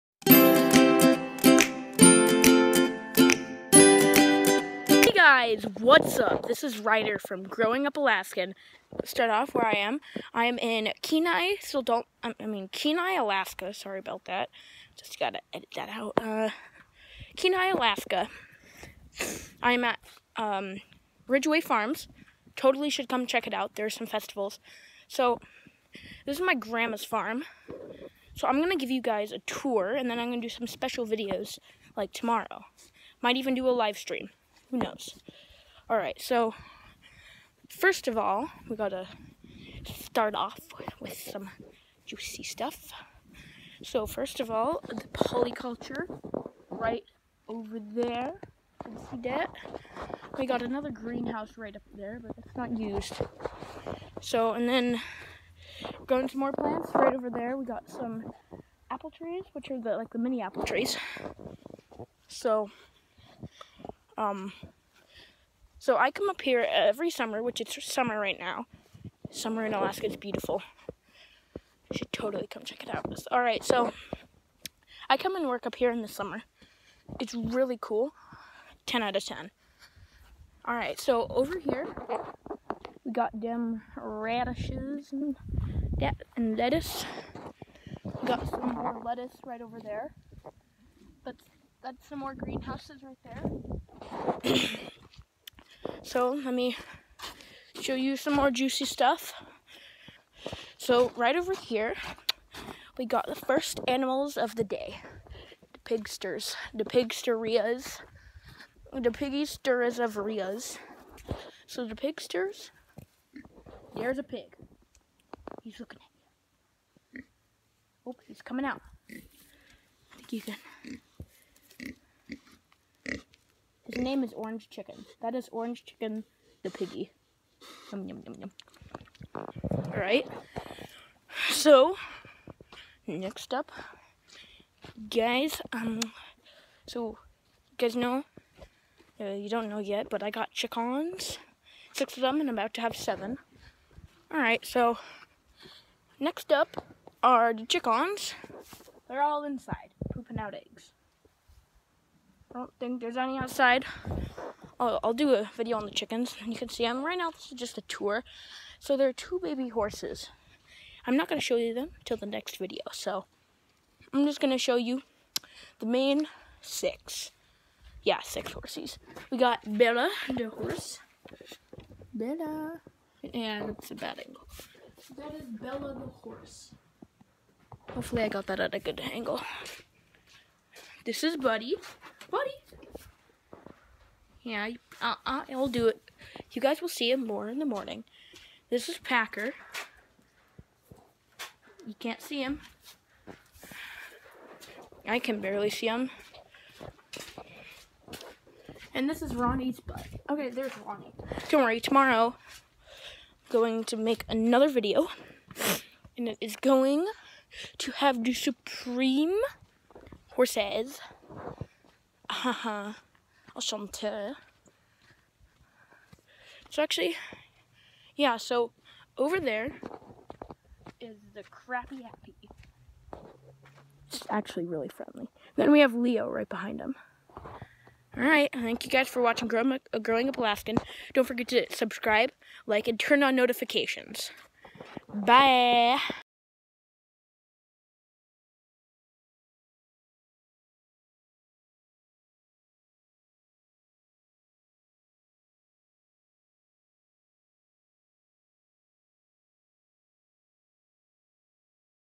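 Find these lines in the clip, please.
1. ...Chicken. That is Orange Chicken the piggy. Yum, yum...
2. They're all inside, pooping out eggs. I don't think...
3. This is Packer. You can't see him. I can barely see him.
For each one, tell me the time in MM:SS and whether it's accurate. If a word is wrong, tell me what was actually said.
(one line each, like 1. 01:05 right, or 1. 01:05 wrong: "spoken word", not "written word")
1. 02:04 right
2. 02:29 right
3. 03:08 right.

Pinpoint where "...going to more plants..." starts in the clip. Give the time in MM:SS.
00:56.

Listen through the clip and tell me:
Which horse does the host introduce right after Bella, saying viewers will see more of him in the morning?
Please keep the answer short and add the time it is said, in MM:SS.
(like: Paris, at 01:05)
Buddy, at 03:01.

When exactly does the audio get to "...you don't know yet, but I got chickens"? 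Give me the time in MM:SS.
02:19.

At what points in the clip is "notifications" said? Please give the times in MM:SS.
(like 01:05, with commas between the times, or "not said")
03:53.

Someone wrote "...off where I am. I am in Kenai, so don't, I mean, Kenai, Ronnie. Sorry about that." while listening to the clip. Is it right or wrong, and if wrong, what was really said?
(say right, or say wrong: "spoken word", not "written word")
wrong: "Alaska", not "Ronnie".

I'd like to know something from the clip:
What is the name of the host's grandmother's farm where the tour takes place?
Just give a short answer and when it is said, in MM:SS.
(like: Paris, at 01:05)
Ridgeway Farms, at 00:21.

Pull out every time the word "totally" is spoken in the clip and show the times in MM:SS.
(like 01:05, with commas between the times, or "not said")
00:22, 01:12.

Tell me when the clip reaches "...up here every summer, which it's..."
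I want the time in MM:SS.
01:06.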